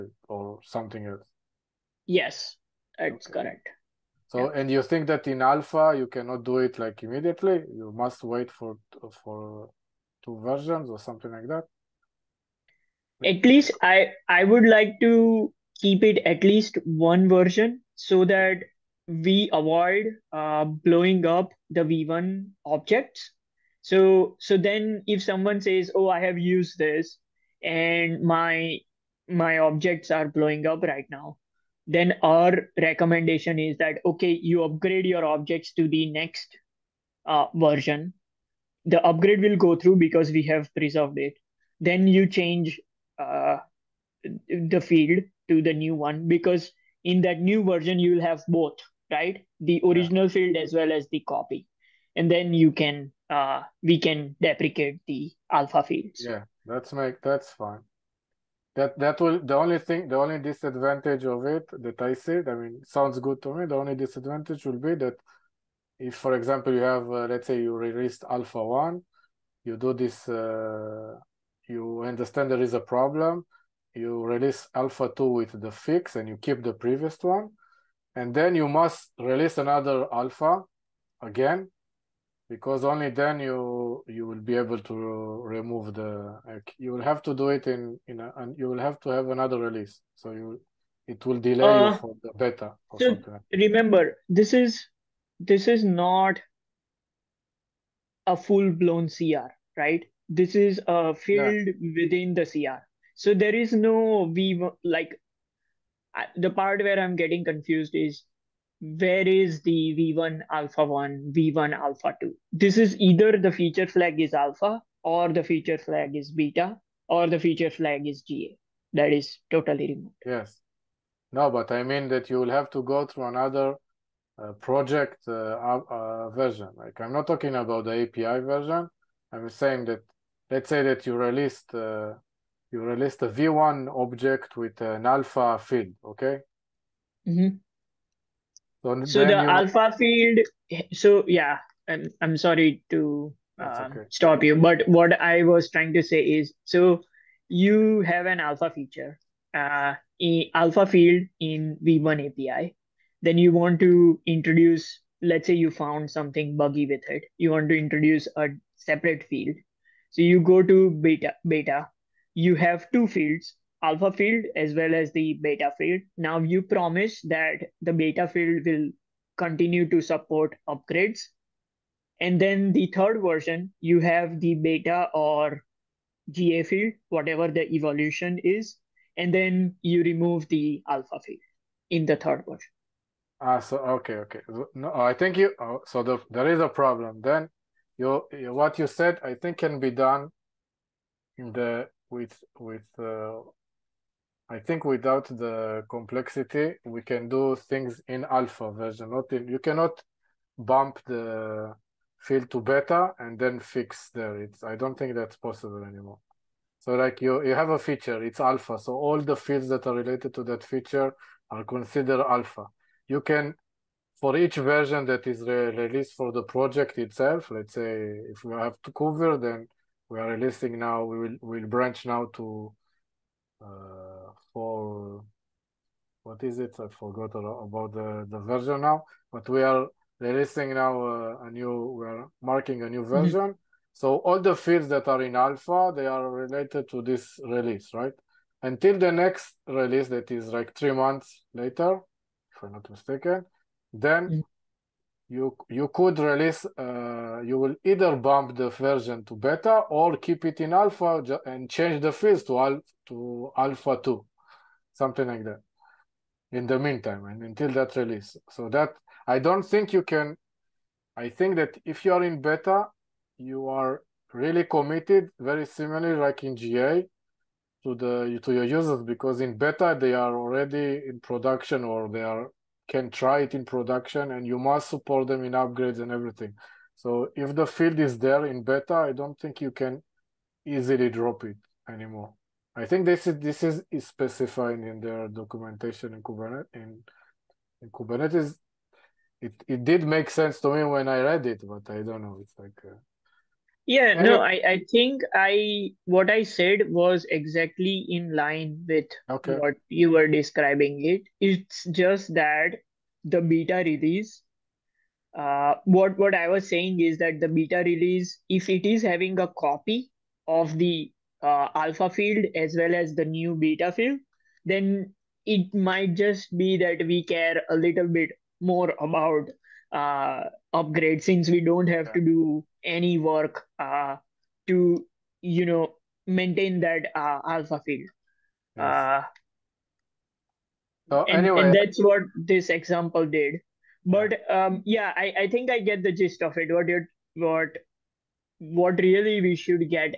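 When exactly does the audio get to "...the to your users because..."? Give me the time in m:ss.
4:27.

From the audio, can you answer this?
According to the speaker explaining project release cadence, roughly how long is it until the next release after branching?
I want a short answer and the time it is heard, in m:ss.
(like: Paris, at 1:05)
3 months, at 4:00.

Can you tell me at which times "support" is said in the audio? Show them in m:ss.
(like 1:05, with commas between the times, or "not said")
2:50, 4:34.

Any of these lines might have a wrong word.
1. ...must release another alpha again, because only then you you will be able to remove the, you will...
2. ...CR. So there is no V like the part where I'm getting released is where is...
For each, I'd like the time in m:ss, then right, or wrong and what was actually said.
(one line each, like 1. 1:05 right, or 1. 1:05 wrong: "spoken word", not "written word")
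1. 1:18 right
2. 1:42 wrong: "confused", not "released".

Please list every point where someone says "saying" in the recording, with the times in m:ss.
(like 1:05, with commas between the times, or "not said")
2:09, 5:06.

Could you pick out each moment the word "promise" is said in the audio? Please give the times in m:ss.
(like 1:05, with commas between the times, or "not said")
2:46.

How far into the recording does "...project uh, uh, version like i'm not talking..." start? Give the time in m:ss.
2:04.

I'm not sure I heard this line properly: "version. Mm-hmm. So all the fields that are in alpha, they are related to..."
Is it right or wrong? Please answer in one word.
right.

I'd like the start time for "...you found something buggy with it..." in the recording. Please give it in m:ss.
2:35.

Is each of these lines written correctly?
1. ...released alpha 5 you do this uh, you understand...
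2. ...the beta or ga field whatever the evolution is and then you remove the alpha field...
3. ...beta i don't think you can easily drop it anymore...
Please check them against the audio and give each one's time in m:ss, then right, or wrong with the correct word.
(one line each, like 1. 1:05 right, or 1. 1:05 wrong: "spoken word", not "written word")
1. 1:07 wrong: "1", not "5"
2. 2:54 right
3. 4:38 right.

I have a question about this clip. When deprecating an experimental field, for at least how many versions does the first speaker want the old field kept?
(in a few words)
1 version.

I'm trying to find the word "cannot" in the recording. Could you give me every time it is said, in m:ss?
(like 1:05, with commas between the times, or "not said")
0:06, 3:19.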